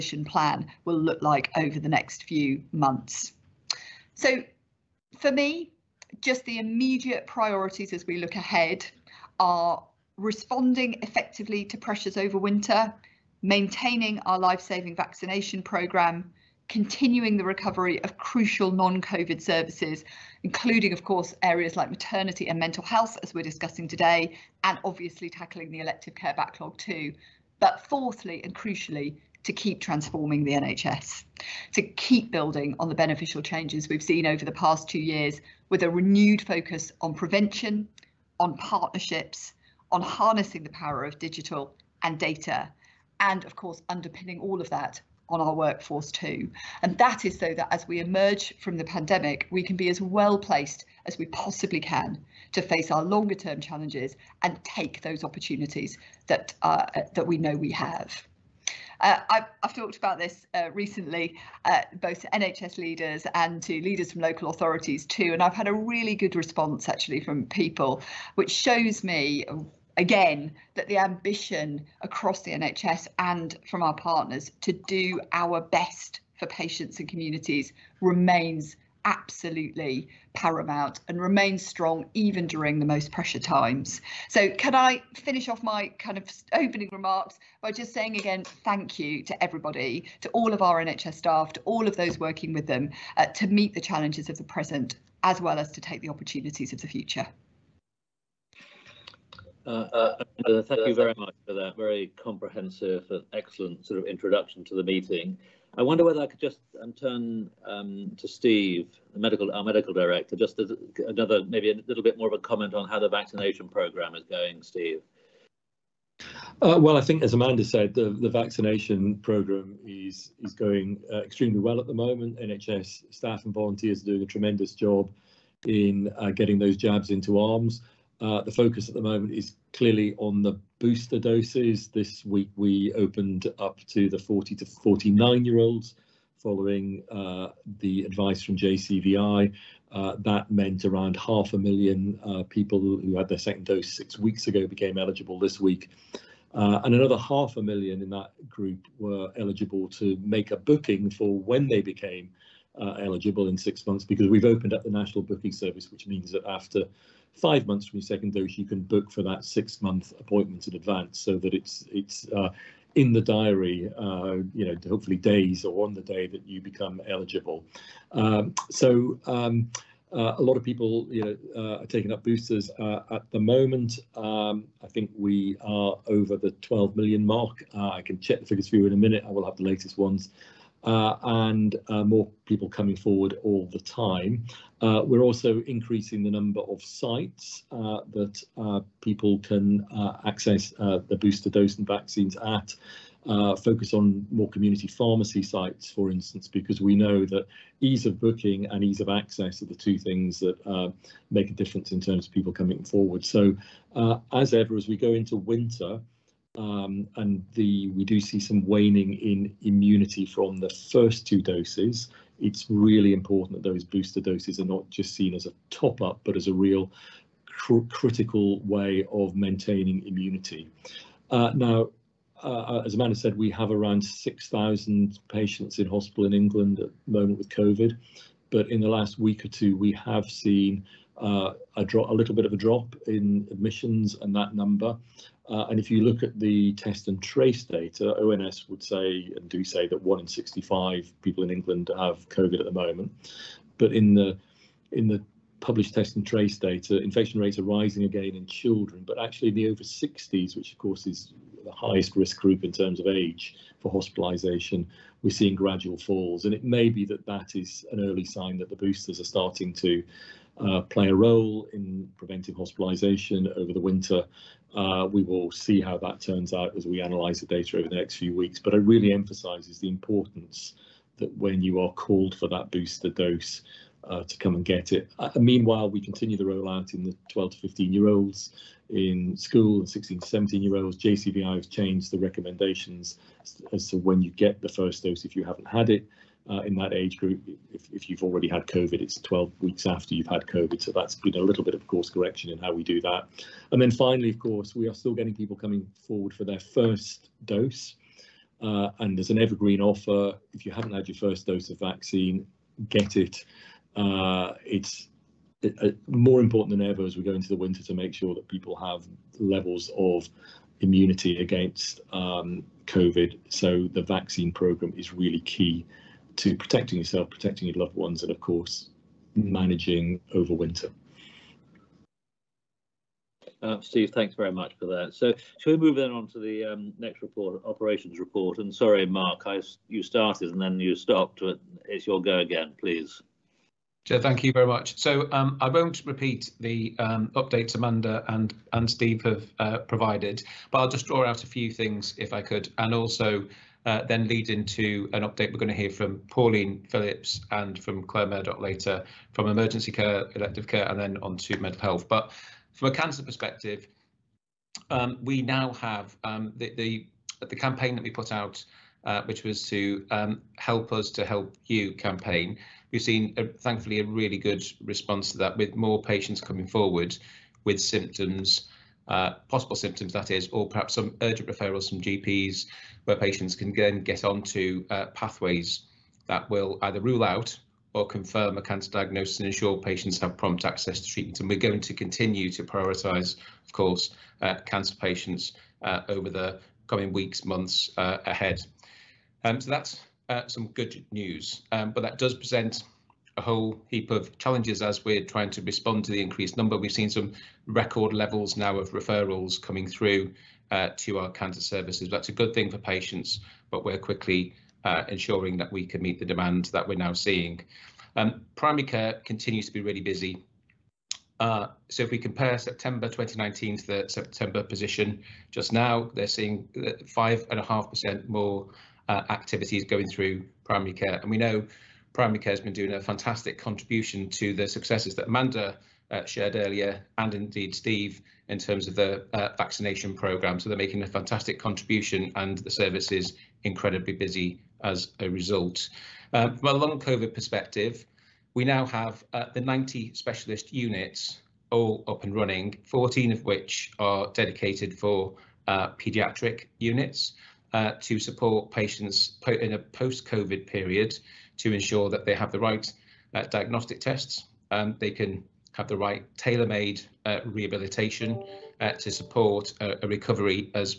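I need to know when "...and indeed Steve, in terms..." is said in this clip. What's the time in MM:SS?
07:07.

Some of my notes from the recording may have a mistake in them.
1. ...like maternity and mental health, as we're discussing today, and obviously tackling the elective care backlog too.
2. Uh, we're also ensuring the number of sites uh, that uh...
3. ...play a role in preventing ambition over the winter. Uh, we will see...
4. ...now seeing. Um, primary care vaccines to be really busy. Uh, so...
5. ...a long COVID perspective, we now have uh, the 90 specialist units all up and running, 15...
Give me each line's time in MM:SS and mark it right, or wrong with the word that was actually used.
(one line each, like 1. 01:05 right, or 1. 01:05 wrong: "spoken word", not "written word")
1. 00:21 right
2. 03:04 wrong: "increasing", not "ensuring"
3. 04:20 wrong: "hospitalisation", not "ambition"
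4. 06:46 wrong: "continues", not "vaccines"
5. 07:16 wrong: "14", not "15".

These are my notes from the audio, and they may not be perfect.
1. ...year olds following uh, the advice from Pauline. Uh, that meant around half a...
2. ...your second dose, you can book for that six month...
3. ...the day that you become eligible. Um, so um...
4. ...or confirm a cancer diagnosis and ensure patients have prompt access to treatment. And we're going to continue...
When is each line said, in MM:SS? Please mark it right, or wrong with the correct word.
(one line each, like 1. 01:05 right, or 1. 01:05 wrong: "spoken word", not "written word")
1. 02:15 wrong: "JCVI", not "Pauline"
2. 02:37 right
3. 02:45 right
4. 06:17 right.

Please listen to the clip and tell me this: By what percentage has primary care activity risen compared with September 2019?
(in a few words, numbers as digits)
5.5%.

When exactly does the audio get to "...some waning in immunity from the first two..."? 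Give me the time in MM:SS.
03:28.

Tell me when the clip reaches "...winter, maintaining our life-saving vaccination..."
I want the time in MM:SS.
00:12.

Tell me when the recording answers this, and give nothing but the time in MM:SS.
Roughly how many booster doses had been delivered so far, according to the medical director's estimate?
02:56.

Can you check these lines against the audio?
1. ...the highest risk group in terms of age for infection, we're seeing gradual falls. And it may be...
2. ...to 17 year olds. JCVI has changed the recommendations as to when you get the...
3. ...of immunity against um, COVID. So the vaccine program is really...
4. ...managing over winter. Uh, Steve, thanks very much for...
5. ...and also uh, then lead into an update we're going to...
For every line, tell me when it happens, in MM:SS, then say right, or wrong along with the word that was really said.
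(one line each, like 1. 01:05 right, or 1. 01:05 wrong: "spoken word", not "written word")
1. 04:11 wrong: "hospitalisation", not "infection"
2. 04:40 right
3. 05:09 right
4. 05:19 right
5. 05:42 right.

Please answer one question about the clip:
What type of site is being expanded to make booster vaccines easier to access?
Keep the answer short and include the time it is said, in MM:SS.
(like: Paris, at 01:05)
community pharmacy, at 03:14.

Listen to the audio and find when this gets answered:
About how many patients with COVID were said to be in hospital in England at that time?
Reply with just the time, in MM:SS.
03:44.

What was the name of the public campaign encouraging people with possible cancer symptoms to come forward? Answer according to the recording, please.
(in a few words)
Help us to help you.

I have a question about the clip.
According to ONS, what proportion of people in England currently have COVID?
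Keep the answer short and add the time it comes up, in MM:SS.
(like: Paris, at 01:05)
1 in 65, at 04:00.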